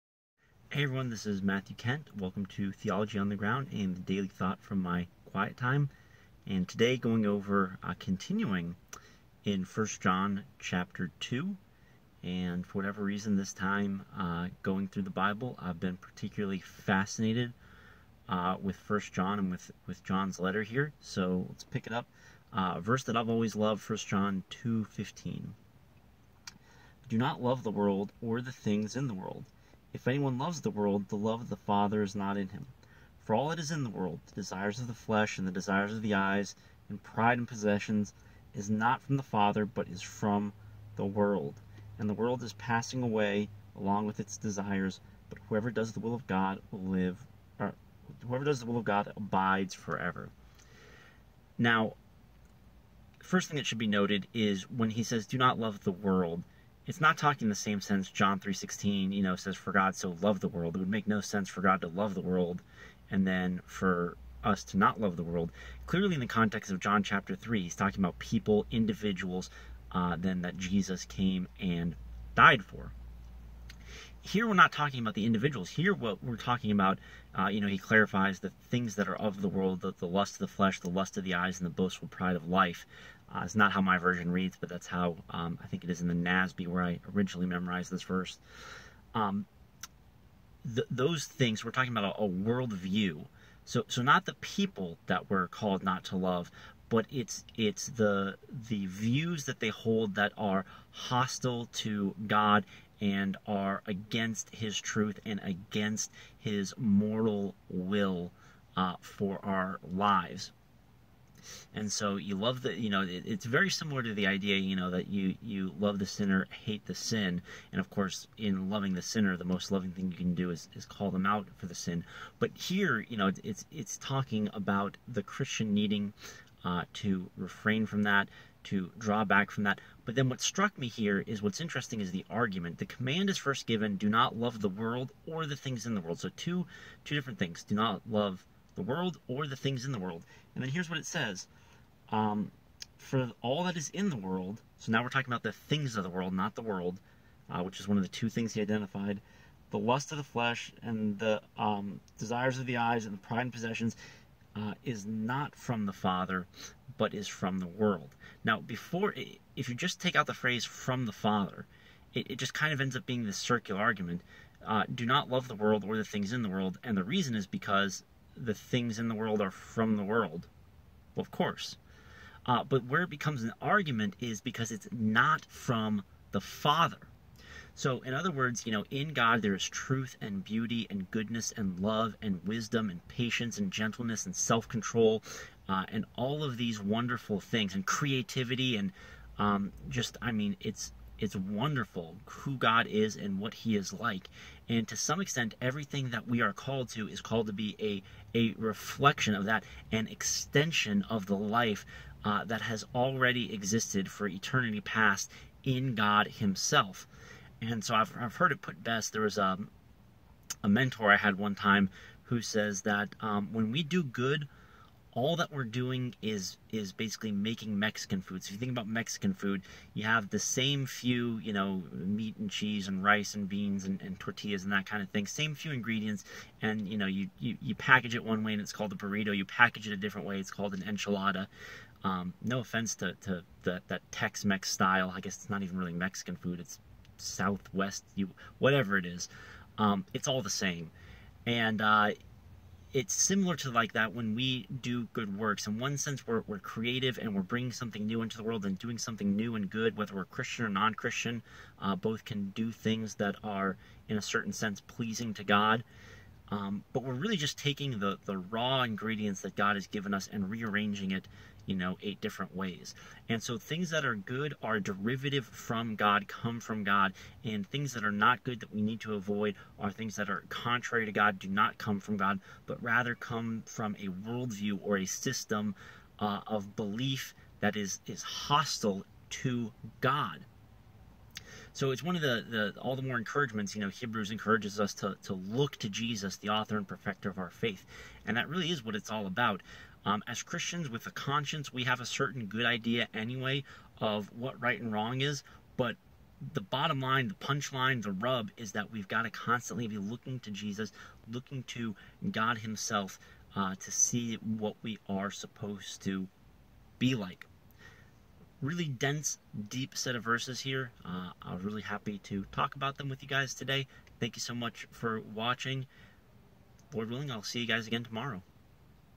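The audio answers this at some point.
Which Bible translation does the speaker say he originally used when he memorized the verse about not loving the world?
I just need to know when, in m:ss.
1:26.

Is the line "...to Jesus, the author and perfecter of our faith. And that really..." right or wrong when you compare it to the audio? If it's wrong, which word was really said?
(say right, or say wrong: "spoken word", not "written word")
right.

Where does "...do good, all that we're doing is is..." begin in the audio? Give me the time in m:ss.
3:33.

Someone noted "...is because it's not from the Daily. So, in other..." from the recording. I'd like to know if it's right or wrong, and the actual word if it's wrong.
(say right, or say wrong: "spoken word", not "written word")
wrong: "Father", not "Daily".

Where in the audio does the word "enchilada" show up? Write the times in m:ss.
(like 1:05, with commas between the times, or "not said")
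3:50.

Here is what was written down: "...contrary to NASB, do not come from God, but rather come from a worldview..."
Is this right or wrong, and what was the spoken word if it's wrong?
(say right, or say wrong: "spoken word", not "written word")
wrong: "God", not "NASB".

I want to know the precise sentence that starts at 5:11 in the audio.
Uh, I was really happy to talk about them with you guys today.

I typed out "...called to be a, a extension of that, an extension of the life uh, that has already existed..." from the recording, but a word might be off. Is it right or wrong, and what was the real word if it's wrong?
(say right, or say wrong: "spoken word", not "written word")
wrong: "reflection", not "extension".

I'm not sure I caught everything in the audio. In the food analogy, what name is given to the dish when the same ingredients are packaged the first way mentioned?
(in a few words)
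Burrito.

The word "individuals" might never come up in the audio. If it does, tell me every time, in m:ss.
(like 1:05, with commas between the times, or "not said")
1:08, 1:15.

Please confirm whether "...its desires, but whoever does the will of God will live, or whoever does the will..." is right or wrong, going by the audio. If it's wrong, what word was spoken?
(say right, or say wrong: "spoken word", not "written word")
right.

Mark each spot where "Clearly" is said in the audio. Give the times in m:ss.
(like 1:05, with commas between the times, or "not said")
1:05.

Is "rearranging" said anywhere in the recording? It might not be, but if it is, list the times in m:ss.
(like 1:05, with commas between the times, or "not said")
4:20.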